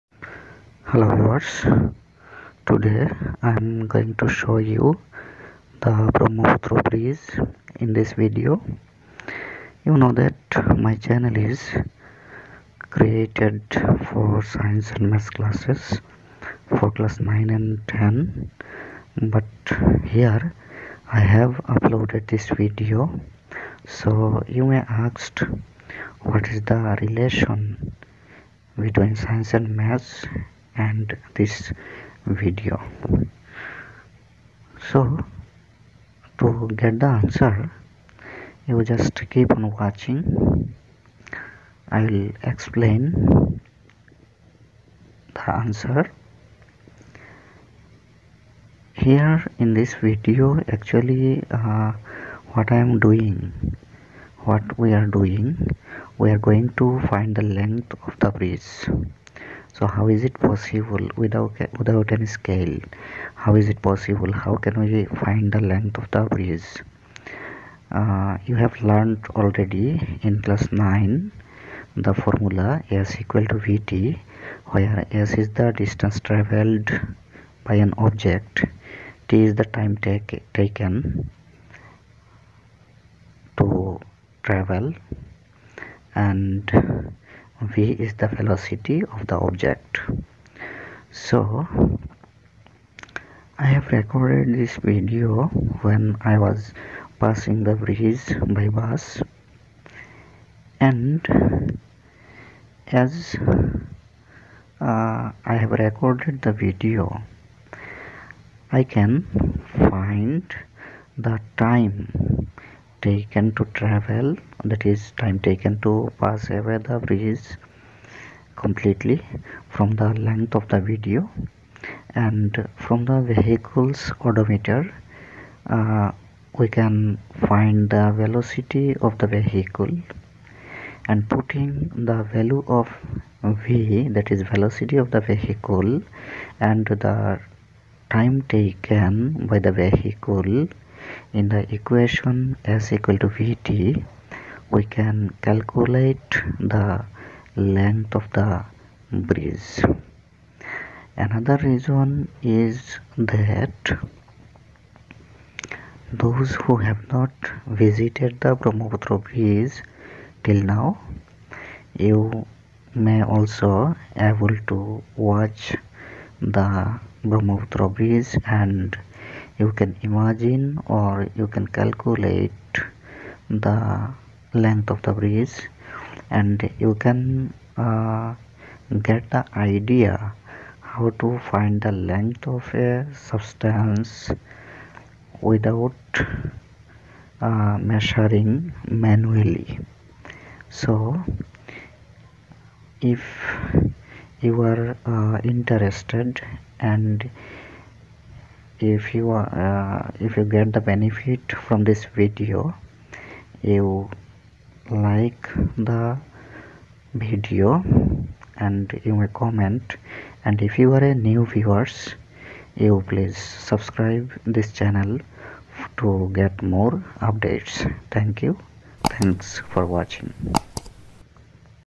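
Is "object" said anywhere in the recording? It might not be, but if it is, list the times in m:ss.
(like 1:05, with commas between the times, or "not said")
1:18, 1:29.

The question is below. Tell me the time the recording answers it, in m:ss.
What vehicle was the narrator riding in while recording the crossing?
1:38.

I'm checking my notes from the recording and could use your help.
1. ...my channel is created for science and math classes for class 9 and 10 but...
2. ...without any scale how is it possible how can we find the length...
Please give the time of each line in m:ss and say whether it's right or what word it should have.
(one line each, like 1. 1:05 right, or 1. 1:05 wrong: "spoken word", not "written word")
1. 0:10 right
2. 1:01 right.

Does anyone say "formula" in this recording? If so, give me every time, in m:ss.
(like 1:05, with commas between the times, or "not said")
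1:12.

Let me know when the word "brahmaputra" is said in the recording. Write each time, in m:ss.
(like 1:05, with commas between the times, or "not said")
0:06, 2:38, 2:47.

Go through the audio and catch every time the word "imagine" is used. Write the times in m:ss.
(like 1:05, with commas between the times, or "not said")
2:50.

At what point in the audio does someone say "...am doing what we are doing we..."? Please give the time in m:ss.
0:52.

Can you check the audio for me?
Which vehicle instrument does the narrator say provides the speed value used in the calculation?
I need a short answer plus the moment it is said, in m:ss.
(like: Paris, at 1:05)
Odometer, at 2:04.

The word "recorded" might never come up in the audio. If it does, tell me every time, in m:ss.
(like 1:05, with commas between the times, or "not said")
1:33, 1:45.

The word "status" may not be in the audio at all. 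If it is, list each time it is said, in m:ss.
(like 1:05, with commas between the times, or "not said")
not said.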